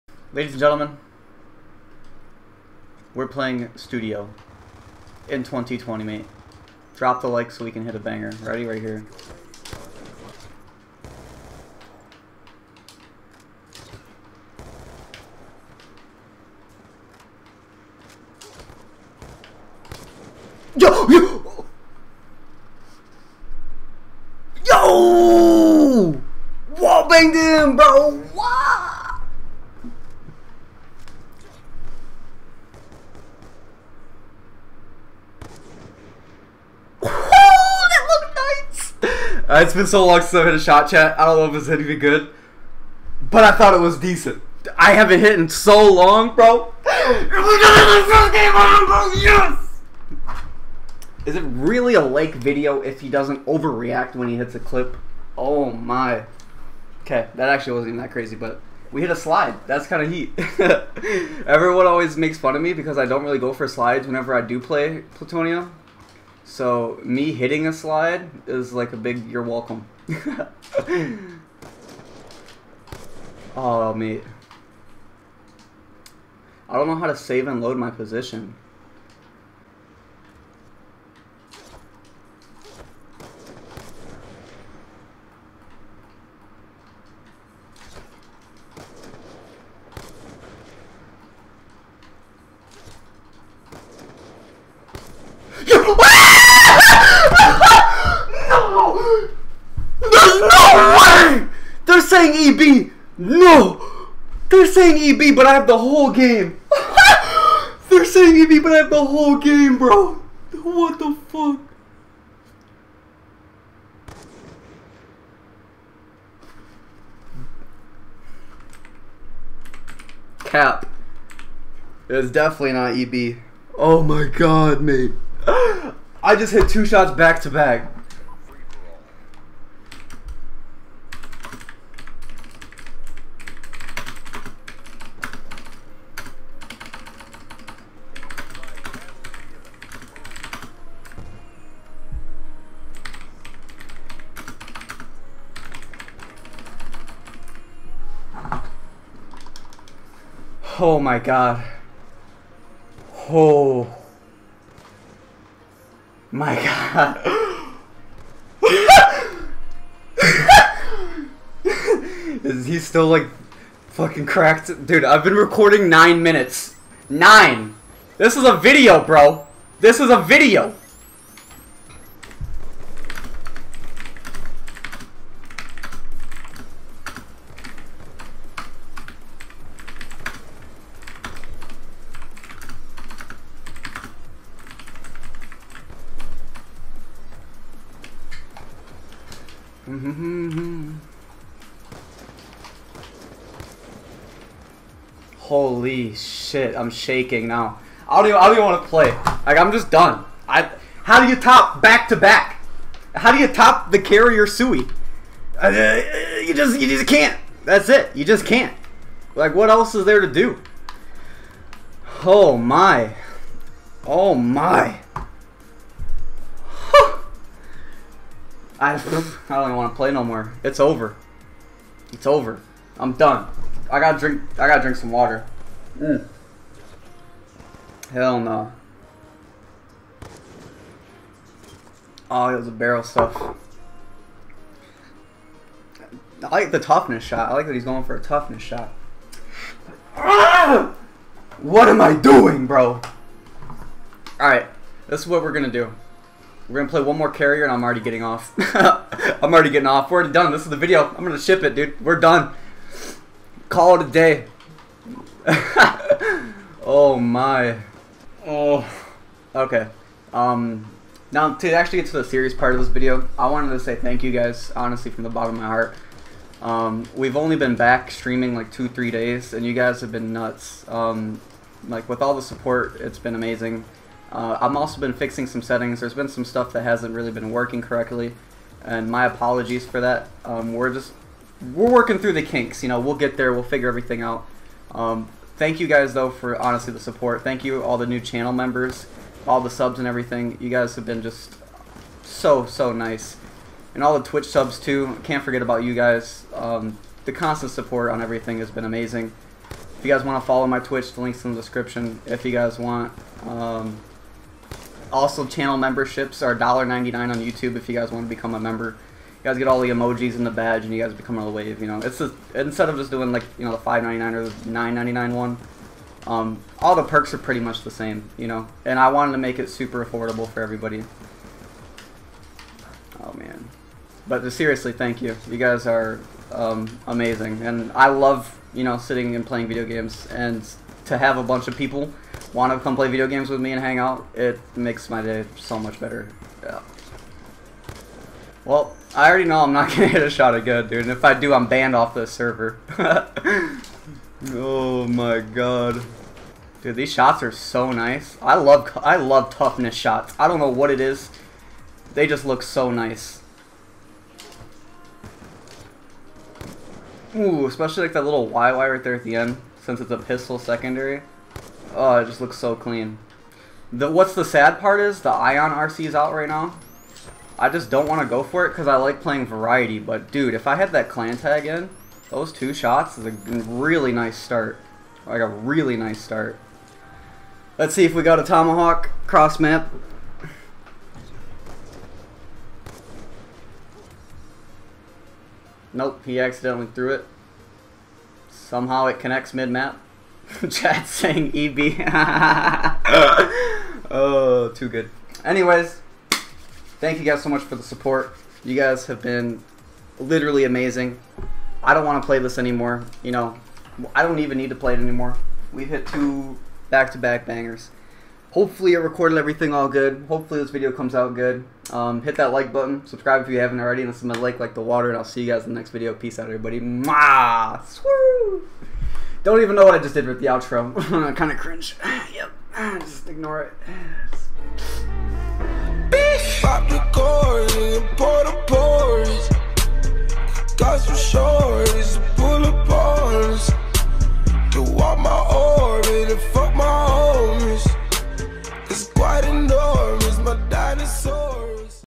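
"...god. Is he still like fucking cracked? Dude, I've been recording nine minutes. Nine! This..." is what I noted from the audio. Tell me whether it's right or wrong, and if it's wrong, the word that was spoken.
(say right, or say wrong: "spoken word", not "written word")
right.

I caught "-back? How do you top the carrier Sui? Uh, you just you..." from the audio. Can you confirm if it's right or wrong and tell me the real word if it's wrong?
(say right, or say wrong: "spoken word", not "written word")
right.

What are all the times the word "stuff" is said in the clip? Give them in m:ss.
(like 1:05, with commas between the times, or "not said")
3:53, 4:36.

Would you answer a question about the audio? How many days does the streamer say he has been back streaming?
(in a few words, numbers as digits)
two, three days.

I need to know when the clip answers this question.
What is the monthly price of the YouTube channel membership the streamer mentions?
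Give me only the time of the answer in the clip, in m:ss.
5:06.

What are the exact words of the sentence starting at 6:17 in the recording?
Let's see if we got a tomahawk cross map.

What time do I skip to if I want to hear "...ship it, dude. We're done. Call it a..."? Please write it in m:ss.
4:11.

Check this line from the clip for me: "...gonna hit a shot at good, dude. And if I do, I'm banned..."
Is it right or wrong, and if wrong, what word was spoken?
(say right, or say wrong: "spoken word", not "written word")
right.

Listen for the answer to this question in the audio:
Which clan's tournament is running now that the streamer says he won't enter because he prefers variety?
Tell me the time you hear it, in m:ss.
6:05.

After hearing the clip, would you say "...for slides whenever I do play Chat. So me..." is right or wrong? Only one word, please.
wrong.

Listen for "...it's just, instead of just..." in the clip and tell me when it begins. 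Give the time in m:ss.
5:12.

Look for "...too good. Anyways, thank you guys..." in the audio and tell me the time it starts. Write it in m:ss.
6:34.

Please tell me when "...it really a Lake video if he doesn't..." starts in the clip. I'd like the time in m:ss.
0:51.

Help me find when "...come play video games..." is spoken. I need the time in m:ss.
5:32.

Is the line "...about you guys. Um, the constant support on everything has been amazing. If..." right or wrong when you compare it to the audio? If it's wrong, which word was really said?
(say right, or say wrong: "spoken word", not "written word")
right.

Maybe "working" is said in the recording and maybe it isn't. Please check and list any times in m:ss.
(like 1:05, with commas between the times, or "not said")
4:37, 4:41.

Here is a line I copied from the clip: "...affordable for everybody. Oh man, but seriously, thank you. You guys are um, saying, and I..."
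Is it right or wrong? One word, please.
wrong.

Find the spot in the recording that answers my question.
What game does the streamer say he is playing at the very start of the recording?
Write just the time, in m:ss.
0:03.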